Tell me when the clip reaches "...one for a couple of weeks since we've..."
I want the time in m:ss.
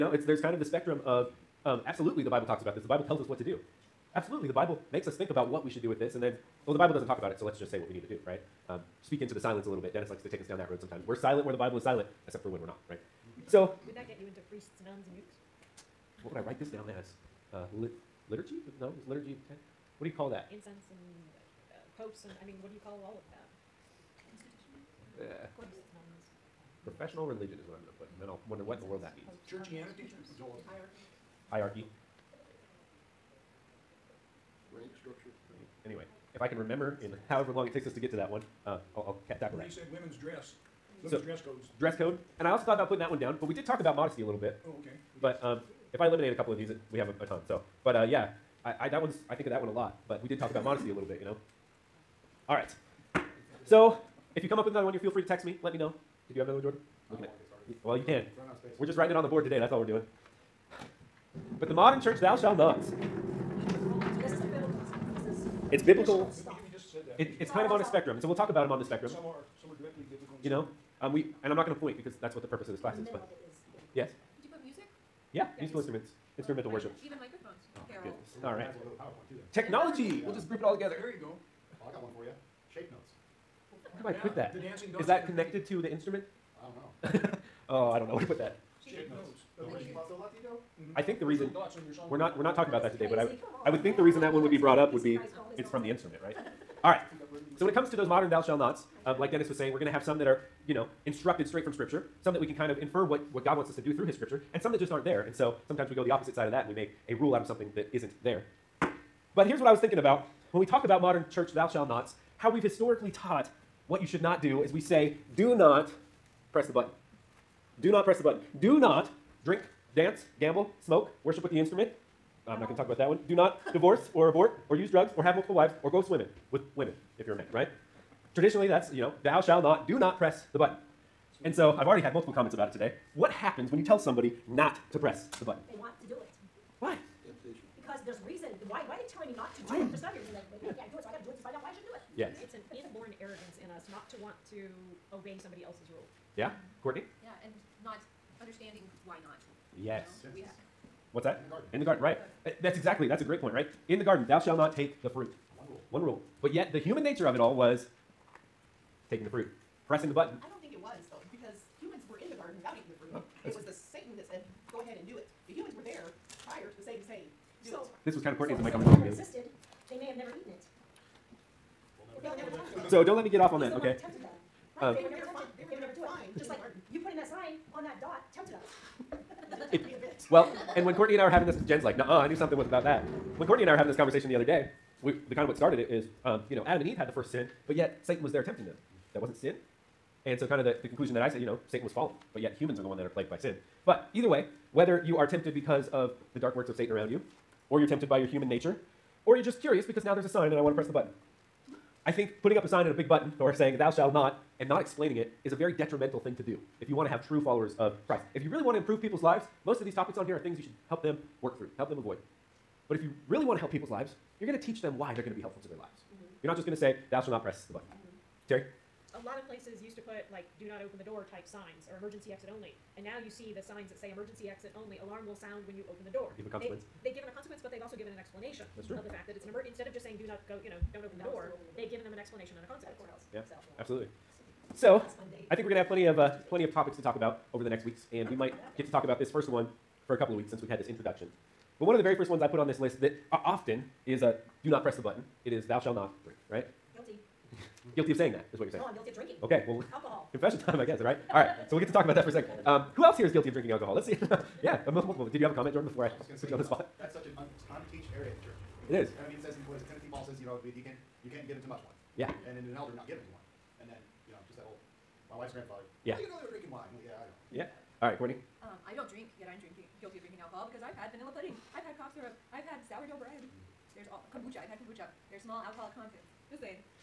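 3:59.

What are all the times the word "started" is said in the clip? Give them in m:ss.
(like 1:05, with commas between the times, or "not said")
3:05.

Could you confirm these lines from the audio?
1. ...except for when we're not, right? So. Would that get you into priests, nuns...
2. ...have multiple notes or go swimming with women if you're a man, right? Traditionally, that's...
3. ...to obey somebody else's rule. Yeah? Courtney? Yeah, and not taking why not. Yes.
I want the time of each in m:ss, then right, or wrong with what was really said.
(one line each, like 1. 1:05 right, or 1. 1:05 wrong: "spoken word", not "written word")
1. 0:12 right
2. 2:05 wrong: "wives", not "notes"
3. 2:24 wrong: "understanding", not "taking".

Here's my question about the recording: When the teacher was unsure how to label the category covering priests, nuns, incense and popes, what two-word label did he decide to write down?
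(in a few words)
Professional religion.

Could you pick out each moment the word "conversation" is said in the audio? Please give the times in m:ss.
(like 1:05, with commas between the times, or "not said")
2:48, 3:03.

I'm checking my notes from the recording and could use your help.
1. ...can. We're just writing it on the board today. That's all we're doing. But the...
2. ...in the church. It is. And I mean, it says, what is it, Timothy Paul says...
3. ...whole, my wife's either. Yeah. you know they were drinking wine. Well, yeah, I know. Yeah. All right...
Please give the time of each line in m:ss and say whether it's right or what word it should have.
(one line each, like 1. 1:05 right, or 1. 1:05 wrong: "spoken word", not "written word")
1. 0:58 right
2. 4:18 right
3. 4:24 wrong: "grandfather", not "either".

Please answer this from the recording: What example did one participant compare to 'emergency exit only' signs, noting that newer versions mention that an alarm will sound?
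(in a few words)
Do not open the door.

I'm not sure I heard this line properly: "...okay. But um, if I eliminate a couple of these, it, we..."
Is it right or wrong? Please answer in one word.
right.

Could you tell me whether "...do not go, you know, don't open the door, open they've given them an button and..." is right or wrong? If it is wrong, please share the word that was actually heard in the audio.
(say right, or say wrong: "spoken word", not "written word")
wrong: "explanation", not "button".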